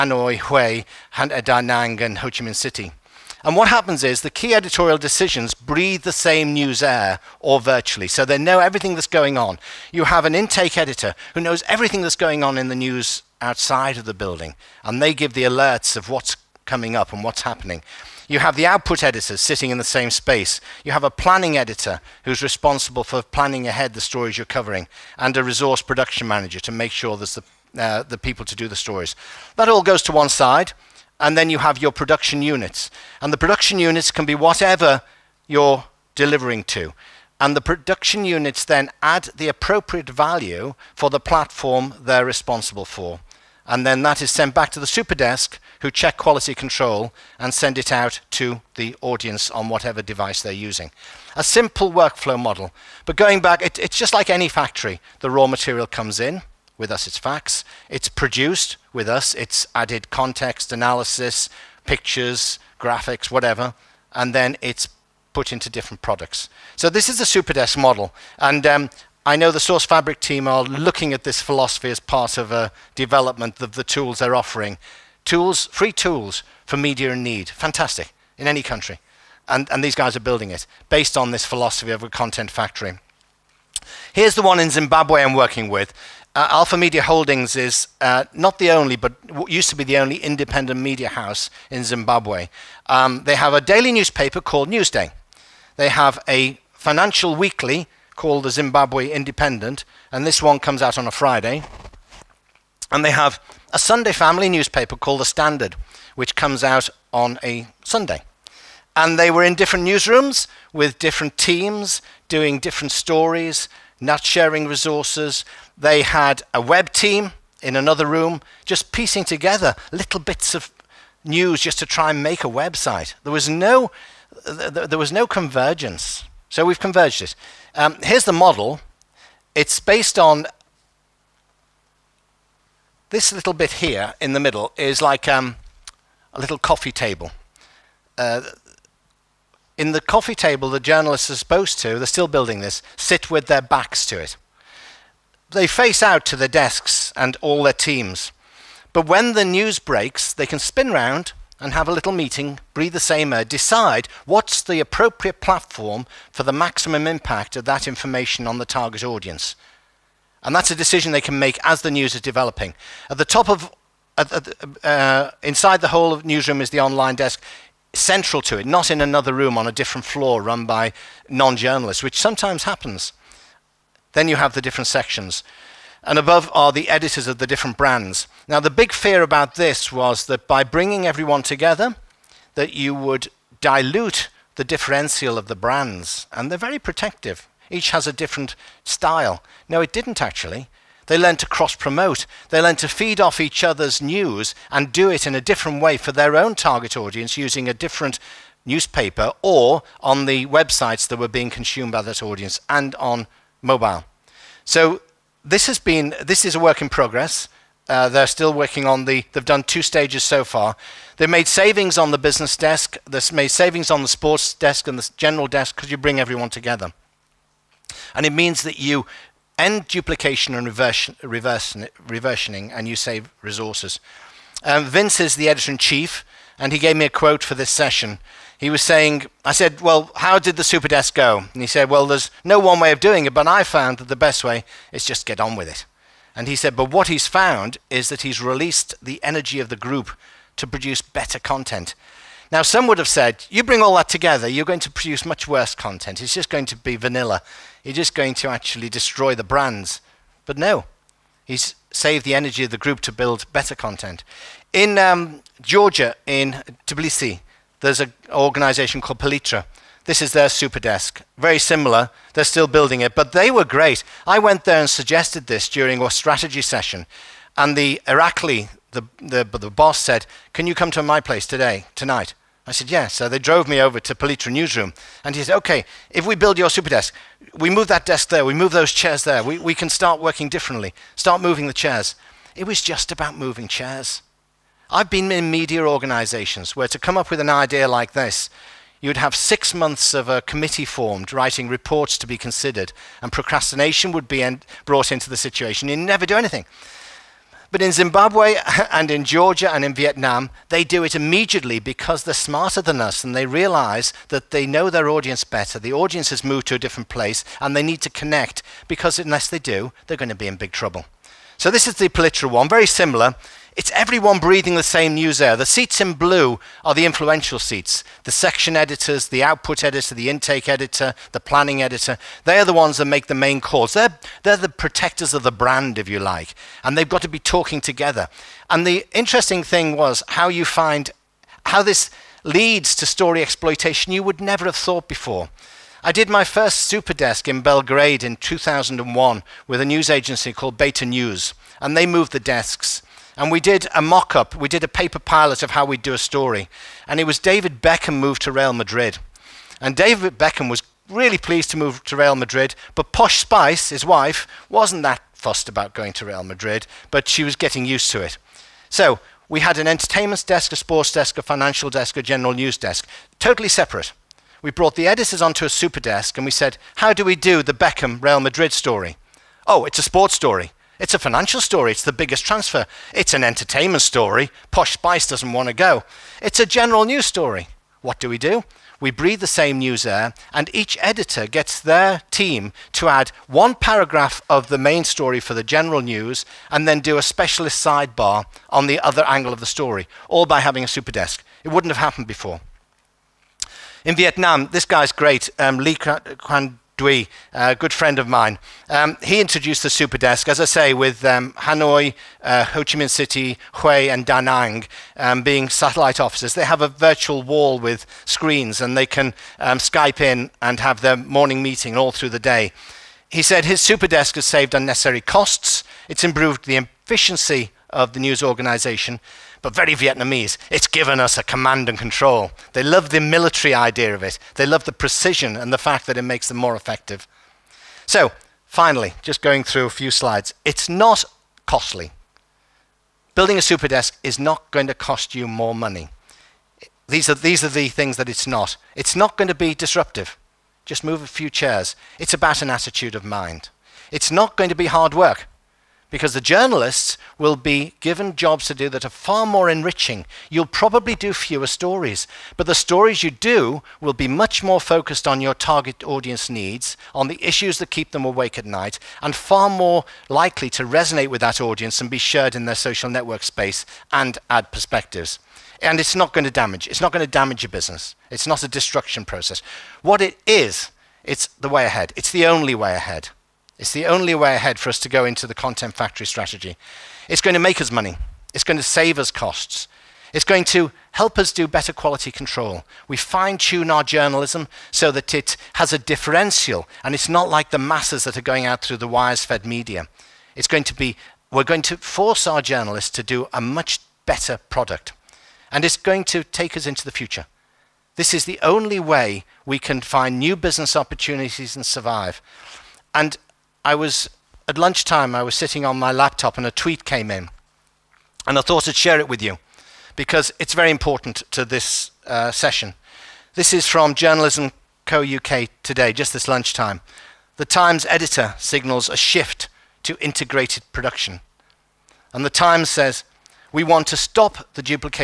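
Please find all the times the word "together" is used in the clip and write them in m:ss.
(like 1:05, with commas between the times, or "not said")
1:59, 3:01, 3:36, 4:04, 5:27.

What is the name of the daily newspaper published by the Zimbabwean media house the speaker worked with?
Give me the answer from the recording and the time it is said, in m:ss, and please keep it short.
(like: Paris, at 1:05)
Newsday, at 1:34.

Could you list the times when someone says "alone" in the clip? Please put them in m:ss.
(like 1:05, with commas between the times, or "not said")
not said.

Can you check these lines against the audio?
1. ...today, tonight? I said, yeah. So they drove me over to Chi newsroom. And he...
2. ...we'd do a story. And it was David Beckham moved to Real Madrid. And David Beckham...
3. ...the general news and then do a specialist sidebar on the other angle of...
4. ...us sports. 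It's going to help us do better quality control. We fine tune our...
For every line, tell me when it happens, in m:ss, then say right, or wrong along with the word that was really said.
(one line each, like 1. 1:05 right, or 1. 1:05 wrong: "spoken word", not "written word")
1. 4:31 wrong: "Palitra", not "Chi"
2. 5:45 right
3. 6:25 right
4. 7:59 wrong: "costs", not "sports".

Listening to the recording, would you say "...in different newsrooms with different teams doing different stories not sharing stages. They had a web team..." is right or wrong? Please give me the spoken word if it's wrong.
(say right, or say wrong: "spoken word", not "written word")
wrong: "resources", not "stages".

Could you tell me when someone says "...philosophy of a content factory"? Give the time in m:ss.
1:21.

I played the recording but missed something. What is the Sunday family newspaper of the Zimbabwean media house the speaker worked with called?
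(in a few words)
The Standard.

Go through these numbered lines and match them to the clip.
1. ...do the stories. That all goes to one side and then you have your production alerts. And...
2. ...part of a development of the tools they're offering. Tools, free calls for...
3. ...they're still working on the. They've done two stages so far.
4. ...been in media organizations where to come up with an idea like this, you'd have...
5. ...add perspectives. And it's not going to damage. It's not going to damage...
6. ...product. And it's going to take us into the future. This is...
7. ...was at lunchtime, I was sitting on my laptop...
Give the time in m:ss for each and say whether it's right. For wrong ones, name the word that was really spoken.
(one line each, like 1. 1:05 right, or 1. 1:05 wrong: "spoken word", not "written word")
1. 0:28 wrong: "units", not "alerts"
2. 1:11 wrong: "tools", not "calls"
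3. 3:28 right
4. 4:45 right
5. 7:44 right
6. 8:14 right
7. 8:23 right.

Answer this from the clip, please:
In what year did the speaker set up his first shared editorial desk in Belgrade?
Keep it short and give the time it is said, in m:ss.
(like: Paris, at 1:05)
2001, at 5:38.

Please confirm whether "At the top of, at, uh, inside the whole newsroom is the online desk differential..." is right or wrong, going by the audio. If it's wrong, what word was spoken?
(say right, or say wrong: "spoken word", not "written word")
wrong: "central", not "differential".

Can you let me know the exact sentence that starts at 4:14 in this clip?
In um, Georgia, in Tbilisi, there's an organization called Palitra.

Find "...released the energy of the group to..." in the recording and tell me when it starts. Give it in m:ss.
3:58.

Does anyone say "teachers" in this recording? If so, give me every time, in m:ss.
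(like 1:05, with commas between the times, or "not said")
not said.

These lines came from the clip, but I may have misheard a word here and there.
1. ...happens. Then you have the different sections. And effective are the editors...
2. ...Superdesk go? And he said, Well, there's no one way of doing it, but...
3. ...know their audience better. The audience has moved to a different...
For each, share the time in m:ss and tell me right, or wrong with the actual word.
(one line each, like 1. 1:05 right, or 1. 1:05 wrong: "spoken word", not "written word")
1. 2:52 wrong: "above", not "effective"
2. 3:50 right
3. 5:04 right.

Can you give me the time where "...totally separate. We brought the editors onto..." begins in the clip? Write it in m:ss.
6:03.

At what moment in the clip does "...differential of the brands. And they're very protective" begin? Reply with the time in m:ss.
3:04.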